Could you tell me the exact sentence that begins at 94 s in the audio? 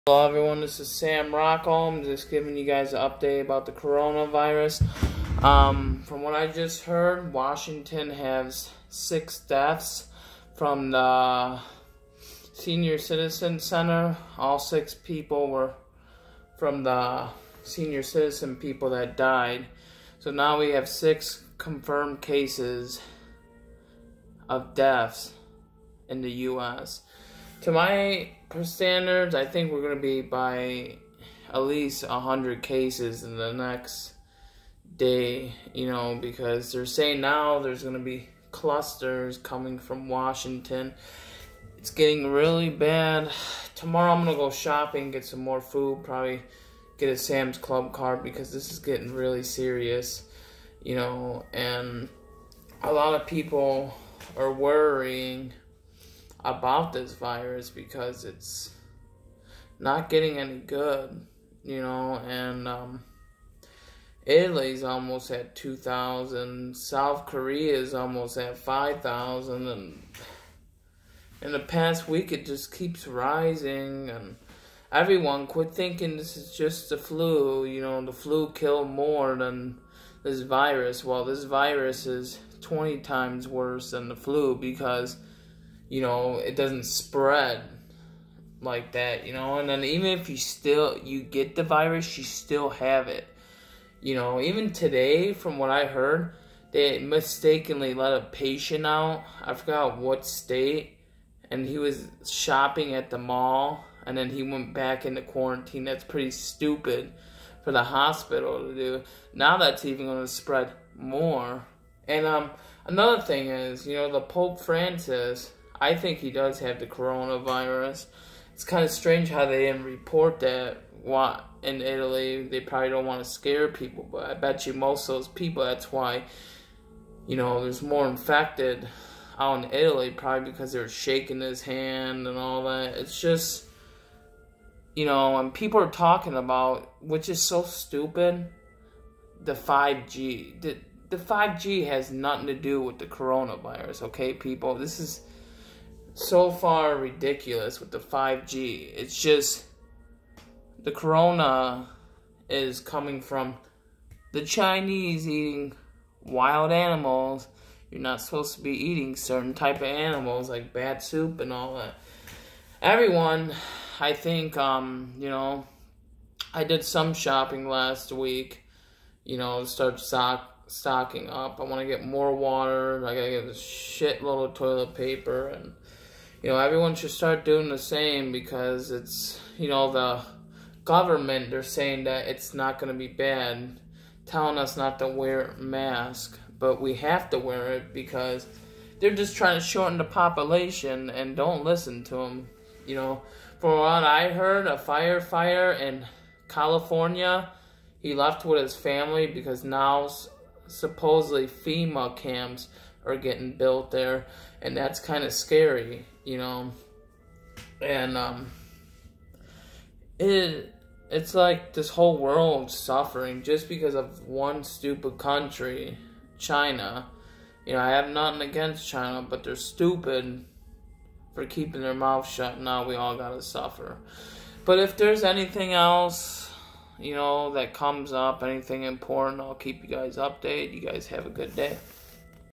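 You know, even today from what I heard, they mistakenly let a patient out.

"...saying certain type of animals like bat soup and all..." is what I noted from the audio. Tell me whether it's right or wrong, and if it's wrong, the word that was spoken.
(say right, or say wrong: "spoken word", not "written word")
wrong: "eating", not "saying".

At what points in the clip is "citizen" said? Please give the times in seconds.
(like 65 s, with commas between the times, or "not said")
12 s, 18 s.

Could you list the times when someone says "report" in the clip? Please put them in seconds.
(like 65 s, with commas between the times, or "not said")
119 s.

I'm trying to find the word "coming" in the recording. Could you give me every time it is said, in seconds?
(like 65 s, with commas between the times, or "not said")
39 s, 152 s.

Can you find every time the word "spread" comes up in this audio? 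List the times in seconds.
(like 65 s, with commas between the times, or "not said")
86 s, 110 s.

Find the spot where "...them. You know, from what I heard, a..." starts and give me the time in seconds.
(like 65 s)
192 s.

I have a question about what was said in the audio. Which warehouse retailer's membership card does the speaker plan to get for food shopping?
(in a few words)
Sam's Club.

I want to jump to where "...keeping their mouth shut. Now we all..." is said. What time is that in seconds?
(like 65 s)
221 s.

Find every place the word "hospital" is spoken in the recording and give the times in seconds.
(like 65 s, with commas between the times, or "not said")
107 s.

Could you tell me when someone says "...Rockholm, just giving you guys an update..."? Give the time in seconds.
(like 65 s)
1 s.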